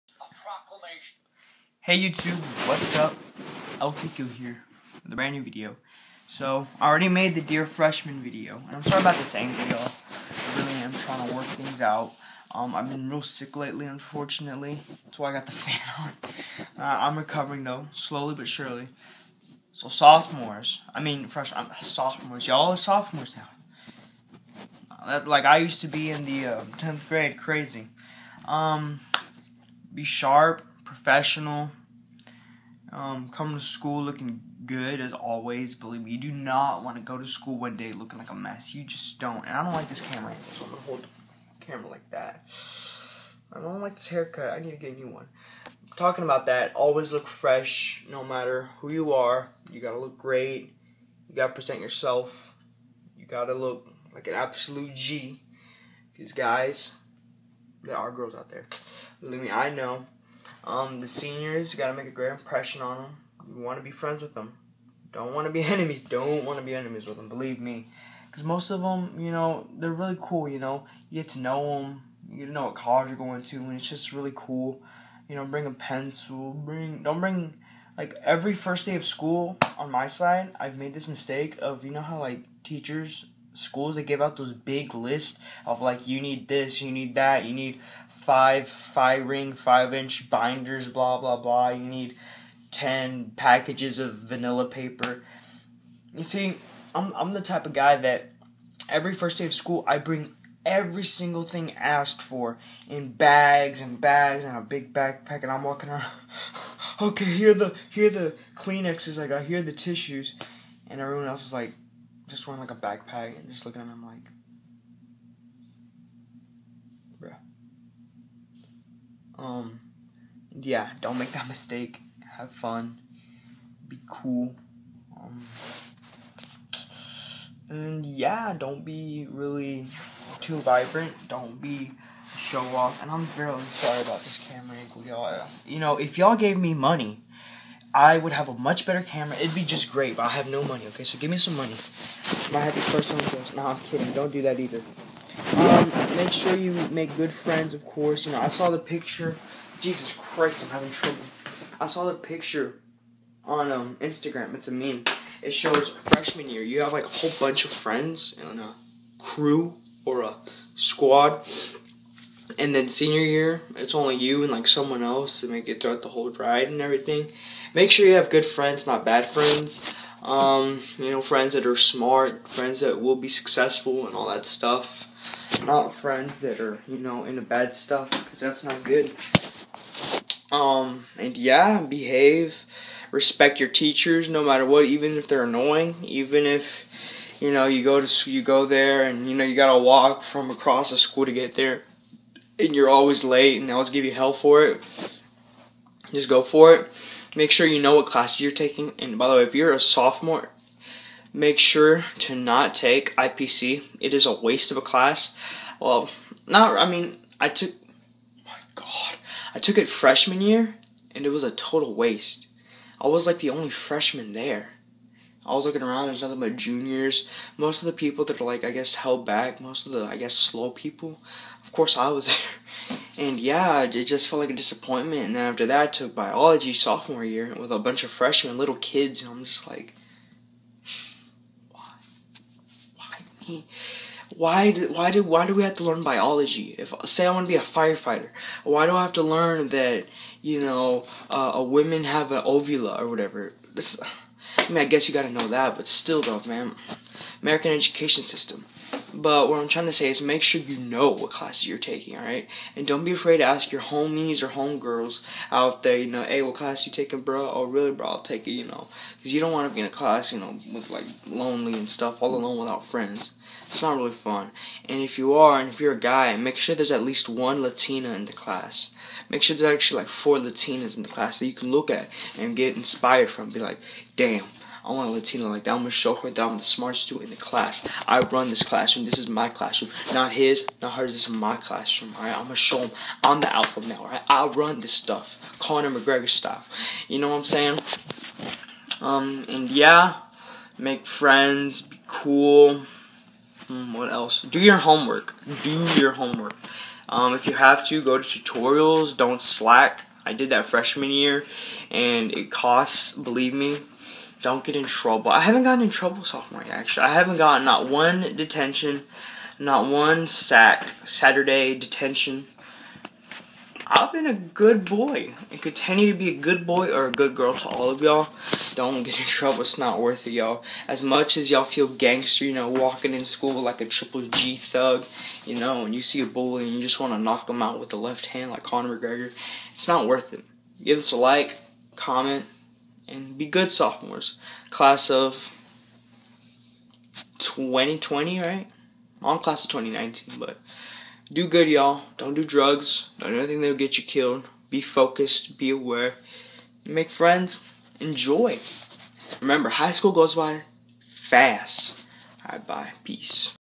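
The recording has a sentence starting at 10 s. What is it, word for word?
I really am trying to work things out.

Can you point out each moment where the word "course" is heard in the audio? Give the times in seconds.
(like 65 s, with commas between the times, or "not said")
147 s, 221 s.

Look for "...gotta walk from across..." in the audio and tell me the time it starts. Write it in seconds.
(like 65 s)
189 s.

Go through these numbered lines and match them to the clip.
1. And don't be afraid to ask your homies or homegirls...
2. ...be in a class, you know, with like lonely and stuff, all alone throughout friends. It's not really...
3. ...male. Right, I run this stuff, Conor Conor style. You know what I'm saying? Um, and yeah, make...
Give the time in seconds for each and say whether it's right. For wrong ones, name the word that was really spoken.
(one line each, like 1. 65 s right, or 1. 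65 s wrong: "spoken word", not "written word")
1. 252 s right
2. 259 s wrong: "without", not "throughout"
3. 283 s wrong: "McGregor", not "Conor".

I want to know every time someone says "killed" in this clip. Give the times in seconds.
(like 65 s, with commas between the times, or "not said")
344 s.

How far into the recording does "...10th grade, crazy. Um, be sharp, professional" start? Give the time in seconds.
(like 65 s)
26 s.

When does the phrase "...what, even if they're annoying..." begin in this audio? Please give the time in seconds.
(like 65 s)
184 s.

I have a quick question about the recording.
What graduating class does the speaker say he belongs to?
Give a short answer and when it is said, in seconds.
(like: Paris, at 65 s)
Class of 2019, at 339 s.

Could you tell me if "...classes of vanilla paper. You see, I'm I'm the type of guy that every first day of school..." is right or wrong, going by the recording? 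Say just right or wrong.
wrong.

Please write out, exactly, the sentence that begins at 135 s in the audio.
You know, if y'all gave me money I would have a much better camera.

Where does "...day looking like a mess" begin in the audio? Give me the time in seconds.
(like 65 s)
37 s.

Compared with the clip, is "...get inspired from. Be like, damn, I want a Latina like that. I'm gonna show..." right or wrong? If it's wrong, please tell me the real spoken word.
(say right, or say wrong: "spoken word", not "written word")
right.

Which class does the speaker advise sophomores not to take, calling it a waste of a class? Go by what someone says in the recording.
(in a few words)
IPC.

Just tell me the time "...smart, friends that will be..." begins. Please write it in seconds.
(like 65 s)
171 s.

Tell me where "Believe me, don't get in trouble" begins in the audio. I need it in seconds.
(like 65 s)
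303 s.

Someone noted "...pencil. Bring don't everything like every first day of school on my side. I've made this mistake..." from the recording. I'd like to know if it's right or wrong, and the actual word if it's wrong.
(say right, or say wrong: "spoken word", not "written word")
wrong: "bring", not "everything".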